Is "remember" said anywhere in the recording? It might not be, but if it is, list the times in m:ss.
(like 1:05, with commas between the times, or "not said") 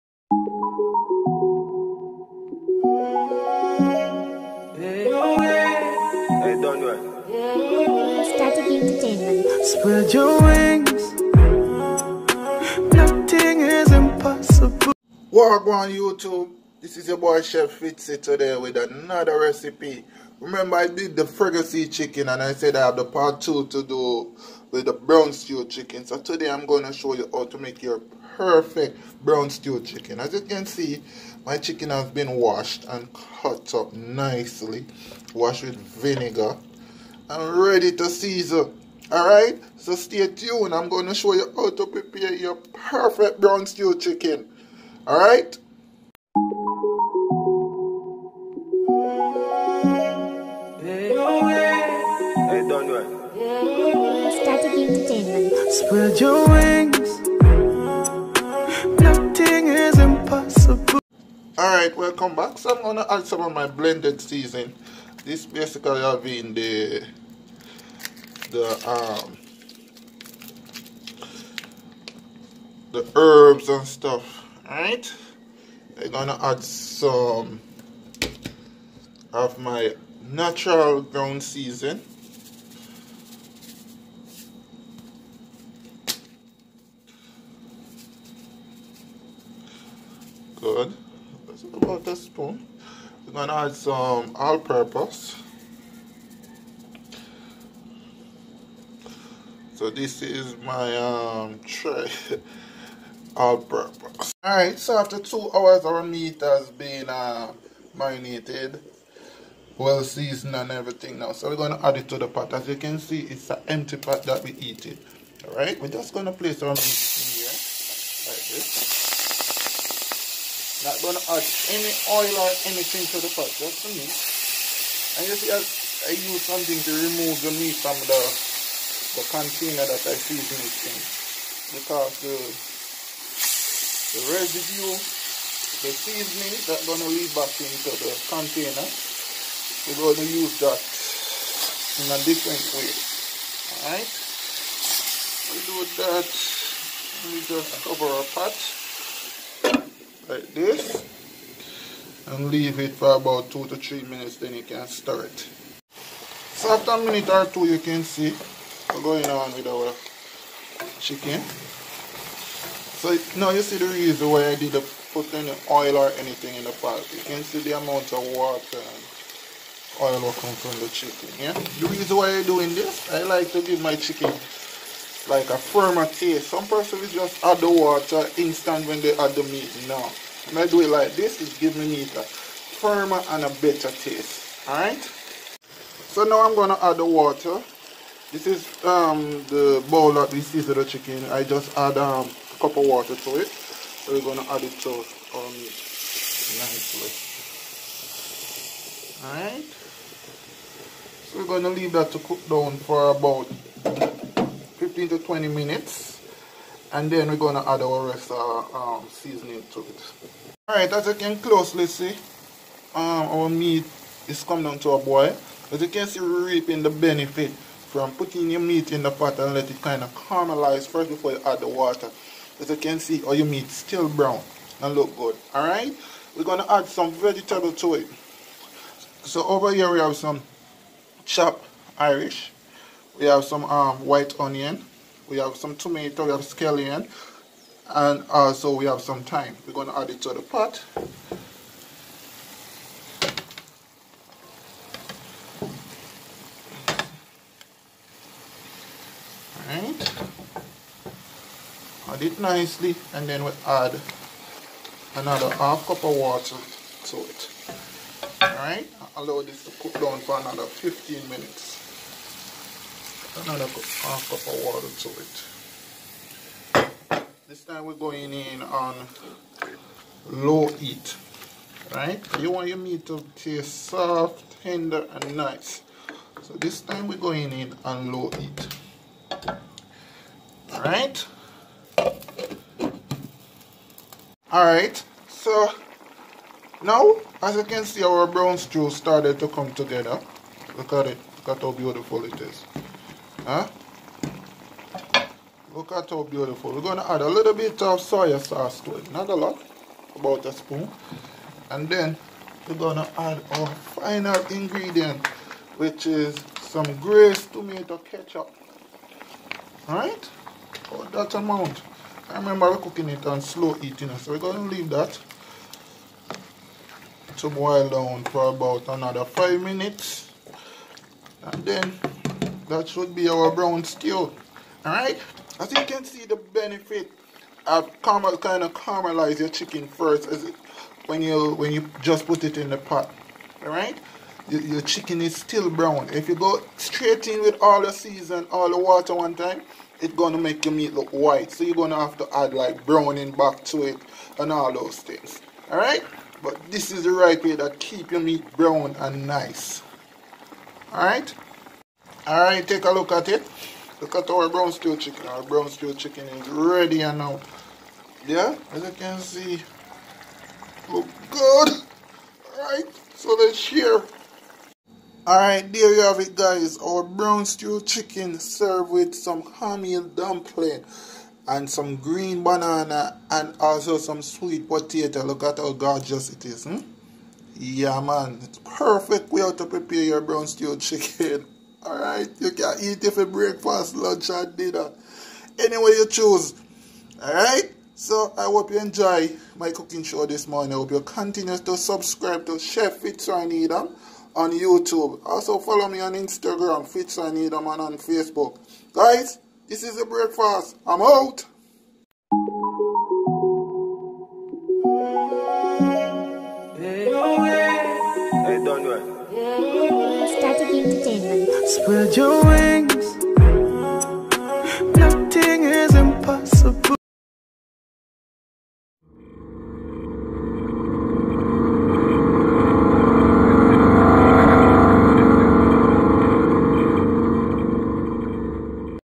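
0:20, 5:12.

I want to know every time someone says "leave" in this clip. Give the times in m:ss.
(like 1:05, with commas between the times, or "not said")
2:17, 2:32, 3:21, 5:14.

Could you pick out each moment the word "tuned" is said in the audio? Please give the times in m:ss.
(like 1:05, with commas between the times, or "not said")
0:40.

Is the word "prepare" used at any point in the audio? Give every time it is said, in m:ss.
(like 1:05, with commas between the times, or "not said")
0:41, 6:19.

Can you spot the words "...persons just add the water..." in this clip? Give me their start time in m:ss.
2:56.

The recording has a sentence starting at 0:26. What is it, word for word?
So today I'm going to show you how to make your perfect brown stew chicken.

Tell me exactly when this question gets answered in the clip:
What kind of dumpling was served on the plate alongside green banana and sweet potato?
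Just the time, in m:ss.
6:09.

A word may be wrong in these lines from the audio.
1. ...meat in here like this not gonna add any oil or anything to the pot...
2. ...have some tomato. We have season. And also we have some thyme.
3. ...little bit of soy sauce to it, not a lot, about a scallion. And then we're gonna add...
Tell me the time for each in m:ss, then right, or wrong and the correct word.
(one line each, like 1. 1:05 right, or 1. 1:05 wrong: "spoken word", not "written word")
1. 1:56 right
2. 3:55 wrong: "scallion", not "season"
3. 4:57 wrong: "spoon", not "scallion".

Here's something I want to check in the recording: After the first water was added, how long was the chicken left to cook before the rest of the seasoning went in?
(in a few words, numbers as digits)
15 to 20 minutes.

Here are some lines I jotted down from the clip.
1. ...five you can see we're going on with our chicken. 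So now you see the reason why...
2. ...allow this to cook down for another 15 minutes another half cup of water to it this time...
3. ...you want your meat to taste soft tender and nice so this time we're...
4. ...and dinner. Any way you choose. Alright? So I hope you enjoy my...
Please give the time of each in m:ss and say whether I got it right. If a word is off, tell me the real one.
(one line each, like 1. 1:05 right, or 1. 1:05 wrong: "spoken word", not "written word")
1. 2:37 wrong: "two", not "five"
2. 4:19 right
3. 4:32 right
4. 6:24 right.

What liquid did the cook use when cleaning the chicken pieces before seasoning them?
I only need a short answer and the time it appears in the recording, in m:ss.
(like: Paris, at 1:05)
Vinegar, at 0:35.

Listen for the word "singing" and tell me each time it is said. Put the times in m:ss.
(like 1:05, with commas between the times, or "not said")
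not said.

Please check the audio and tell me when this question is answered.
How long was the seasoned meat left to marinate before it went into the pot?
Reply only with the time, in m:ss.
1:45.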